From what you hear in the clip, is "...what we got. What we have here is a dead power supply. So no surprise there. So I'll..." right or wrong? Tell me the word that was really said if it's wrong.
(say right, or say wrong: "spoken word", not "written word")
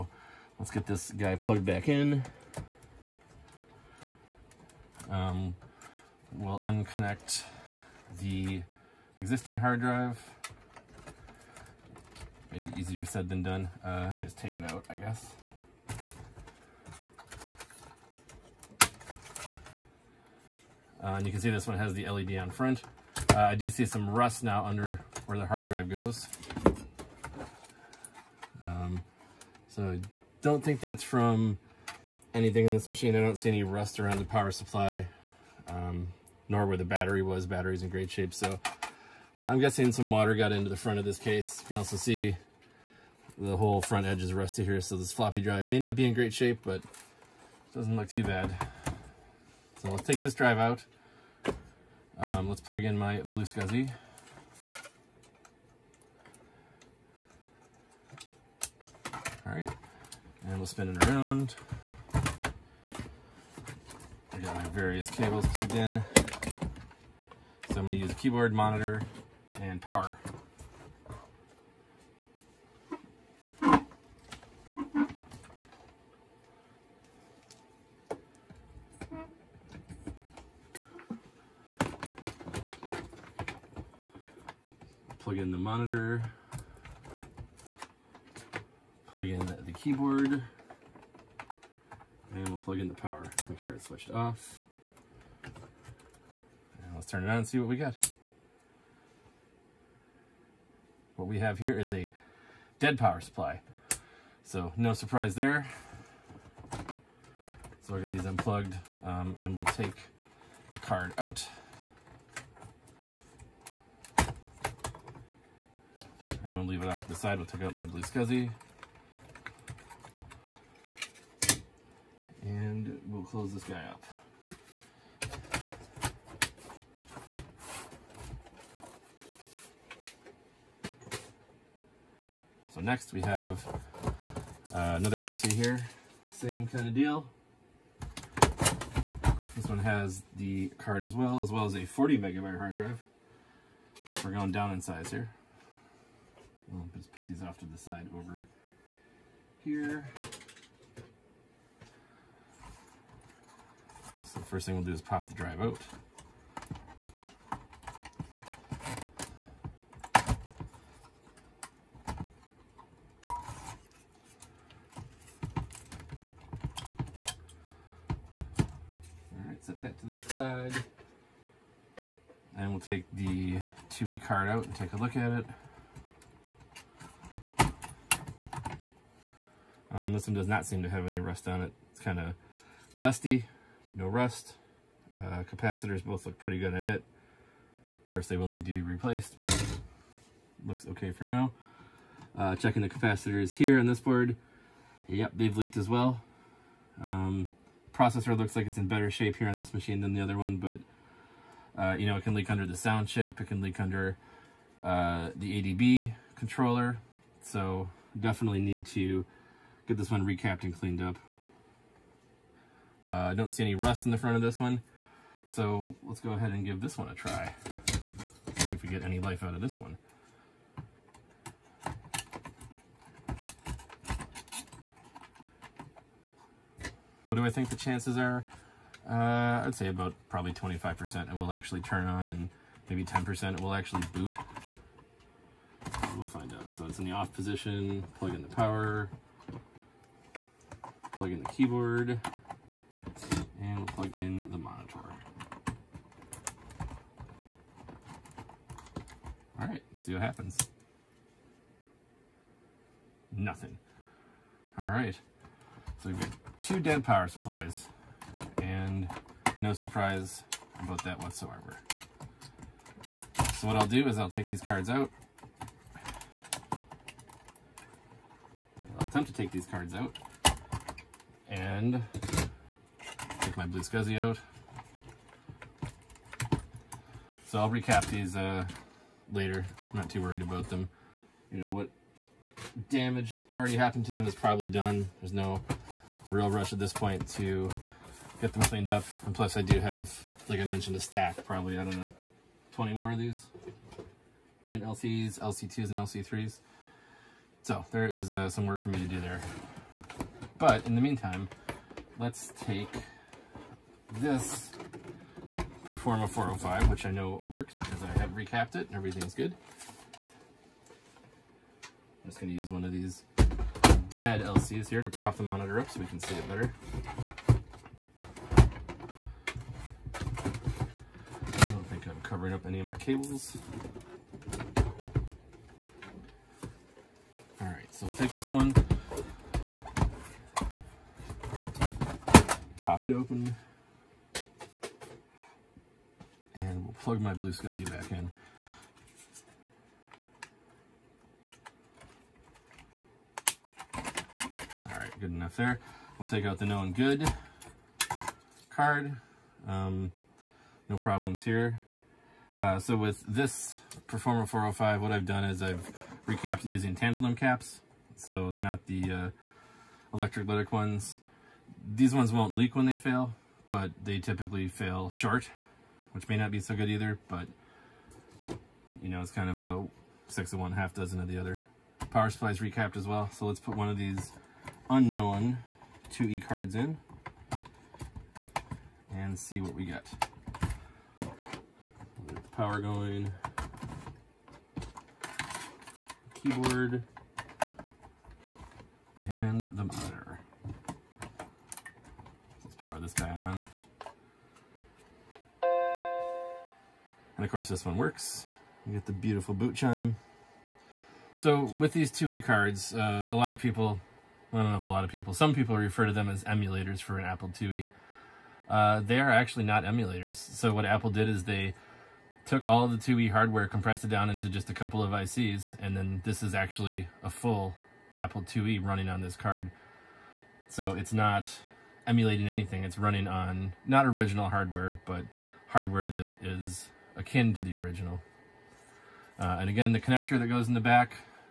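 right.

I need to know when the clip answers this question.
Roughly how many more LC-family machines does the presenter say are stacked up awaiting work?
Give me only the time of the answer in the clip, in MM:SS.
04:52.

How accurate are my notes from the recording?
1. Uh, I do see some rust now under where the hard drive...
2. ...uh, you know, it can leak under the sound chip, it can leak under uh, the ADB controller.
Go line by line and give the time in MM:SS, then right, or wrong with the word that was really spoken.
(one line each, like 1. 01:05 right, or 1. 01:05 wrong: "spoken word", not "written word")
1. 00:23 right
2. 03:21 right.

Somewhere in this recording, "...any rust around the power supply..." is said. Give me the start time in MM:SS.
00:33.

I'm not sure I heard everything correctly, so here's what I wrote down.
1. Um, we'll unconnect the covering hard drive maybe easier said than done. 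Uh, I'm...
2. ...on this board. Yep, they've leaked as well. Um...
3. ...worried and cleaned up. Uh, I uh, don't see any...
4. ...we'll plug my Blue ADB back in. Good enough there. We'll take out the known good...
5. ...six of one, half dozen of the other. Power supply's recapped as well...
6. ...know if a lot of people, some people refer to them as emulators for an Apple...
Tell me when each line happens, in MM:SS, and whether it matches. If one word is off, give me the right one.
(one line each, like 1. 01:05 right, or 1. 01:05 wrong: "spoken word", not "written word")
1. 00:05 wrong: "existing", not "covering"
2. 03:13 right
3. 03:30 wrong: "recapped", not "worried"
4. 05:36 wrong: "SCSI", not "ADB"
5. 06:10 right
6. 06:44 right.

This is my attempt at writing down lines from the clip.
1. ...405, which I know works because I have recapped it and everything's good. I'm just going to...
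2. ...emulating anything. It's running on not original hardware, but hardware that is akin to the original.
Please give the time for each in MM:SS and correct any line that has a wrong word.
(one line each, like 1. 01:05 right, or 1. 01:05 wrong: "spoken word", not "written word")
1. 05:06 right
2. 07:02 right.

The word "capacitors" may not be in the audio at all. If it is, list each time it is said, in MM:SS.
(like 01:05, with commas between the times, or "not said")
03:05, 03:12.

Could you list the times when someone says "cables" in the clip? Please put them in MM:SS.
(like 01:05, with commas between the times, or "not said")
01:05, 05:22.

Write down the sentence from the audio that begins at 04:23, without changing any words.
So what I'll do is I'll take these cards out.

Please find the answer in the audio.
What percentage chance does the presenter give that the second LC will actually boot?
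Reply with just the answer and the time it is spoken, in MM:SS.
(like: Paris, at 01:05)
10%, at 03:53.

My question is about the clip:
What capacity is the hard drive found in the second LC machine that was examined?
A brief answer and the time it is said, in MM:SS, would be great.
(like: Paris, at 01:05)
40 megabyte, at 02:21.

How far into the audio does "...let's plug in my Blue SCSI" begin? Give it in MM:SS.
00:52.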